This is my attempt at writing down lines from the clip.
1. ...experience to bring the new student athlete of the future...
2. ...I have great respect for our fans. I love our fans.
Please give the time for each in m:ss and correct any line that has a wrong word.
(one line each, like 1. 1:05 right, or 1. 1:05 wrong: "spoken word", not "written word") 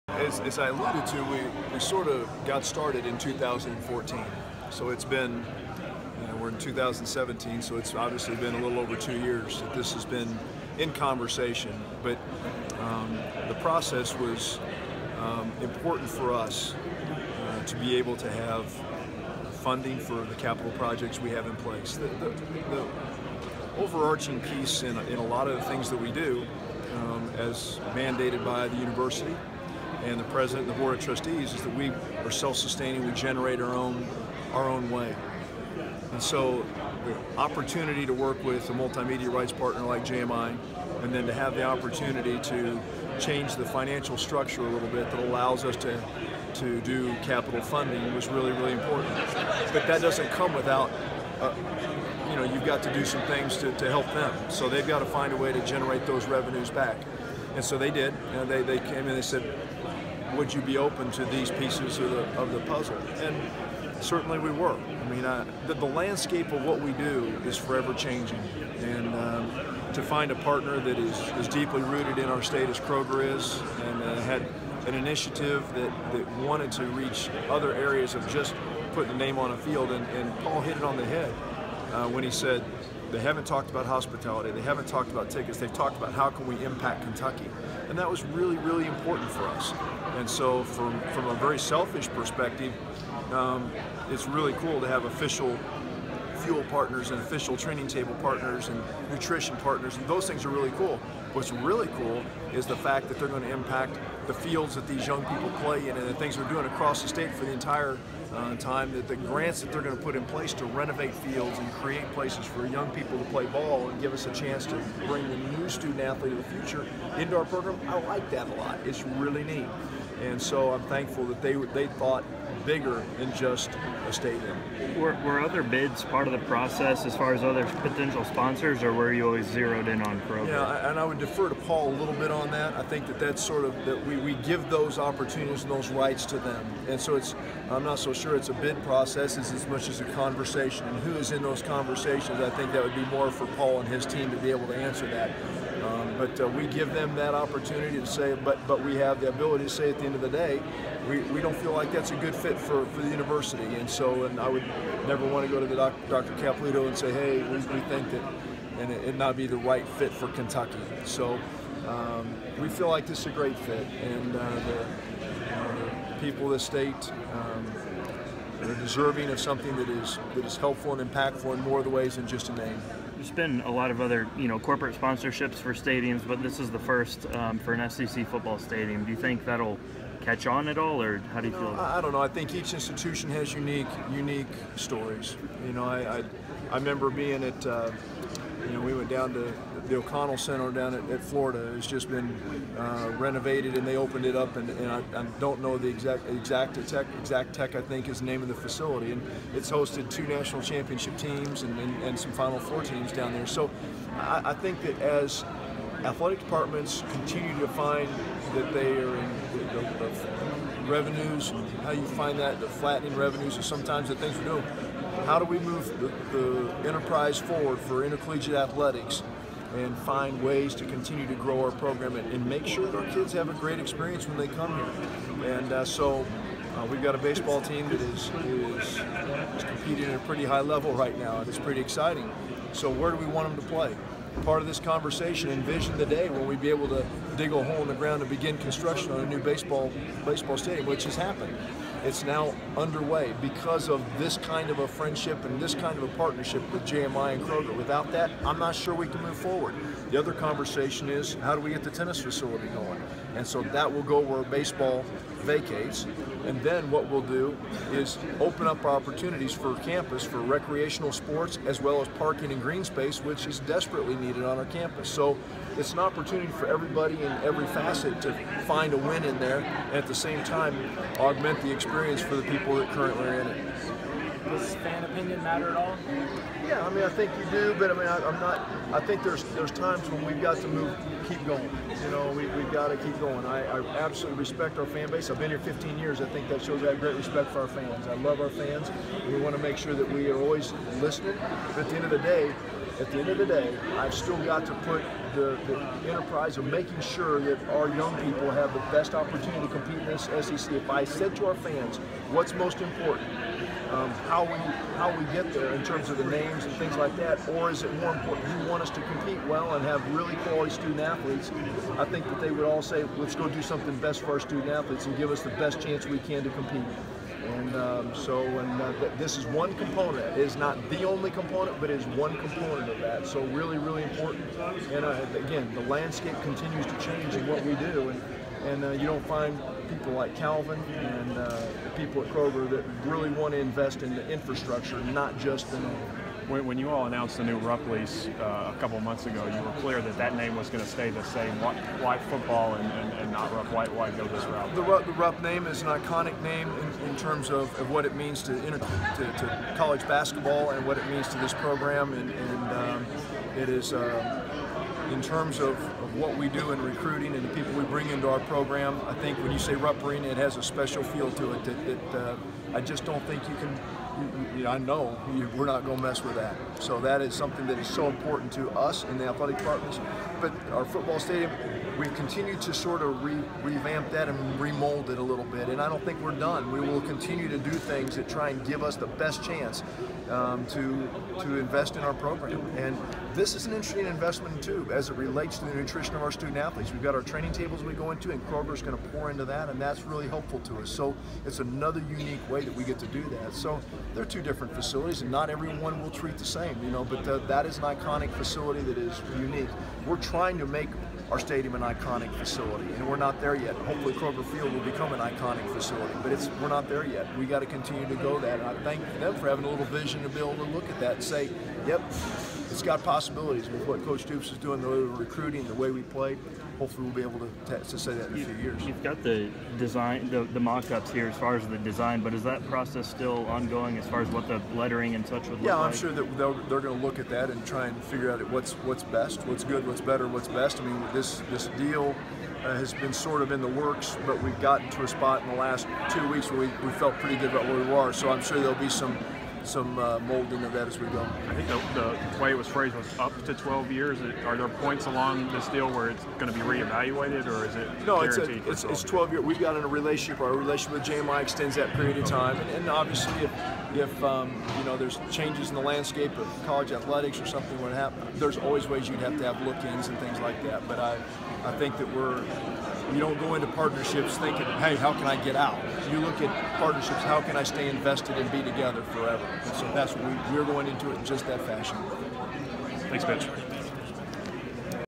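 1. 1:54 wrong: "chance", not "experience"
2. 4:46 right.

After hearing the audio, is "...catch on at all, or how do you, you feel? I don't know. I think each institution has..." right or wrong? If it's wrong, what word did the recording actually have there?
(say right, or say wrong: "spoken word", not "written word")
right.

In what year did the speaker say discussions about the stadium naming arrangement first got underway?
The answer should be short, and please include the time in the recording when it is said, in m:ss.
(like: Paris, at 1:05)
2014, at 0:03.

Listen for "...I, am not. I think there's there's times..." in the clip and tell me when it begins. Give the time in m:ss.
4:38.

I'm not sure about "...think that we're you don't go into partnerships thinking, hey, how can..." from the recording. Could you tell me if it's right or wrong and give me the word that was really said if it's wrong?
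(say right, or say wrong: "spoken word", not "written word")
right.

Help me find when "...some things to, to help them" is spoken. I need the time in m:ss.
0:53.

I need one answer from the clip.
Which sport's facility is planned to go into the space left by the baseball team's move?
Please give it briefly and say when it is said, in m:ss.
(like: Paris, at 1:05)
Tennis, at 4:11.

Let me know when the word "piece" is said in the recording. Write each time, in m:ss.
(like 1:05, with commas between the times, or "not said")
0:24, 1:01.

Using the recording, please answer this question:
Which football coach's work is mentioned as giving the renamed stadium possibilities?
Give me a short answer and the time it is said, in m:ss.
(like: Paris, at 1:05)
Coach Stoops, at 6:54.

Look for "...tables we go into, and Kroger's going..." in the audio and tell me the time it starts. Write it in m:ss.
6:27.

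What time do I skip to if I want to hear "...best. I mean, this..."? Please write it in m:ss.
7:10.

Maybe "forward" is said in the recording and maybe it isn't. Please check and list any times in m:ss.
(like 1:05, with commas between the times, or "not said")
3:37, 4:09.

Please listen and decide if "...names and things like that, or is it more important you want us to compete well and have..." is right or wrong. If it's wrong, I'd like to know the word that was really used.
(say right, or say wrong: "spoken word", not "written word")
right.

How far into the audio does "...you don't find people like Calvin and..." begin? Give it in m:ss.
5:28.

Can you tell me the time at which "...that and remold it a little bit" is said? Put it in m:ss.
6:14.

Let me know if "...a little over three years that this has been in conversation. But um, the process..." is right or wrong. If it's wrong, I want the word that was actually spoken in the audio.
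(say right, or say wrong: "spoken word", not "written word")
wrong: "two", not "three".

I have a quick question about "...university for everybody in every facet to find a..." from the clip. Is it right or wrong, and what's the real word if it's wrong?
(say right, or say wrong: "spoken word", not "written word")
wrong: "opportunity", not "university".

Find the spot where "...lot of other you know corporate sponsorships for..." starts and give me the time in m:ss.
2:53.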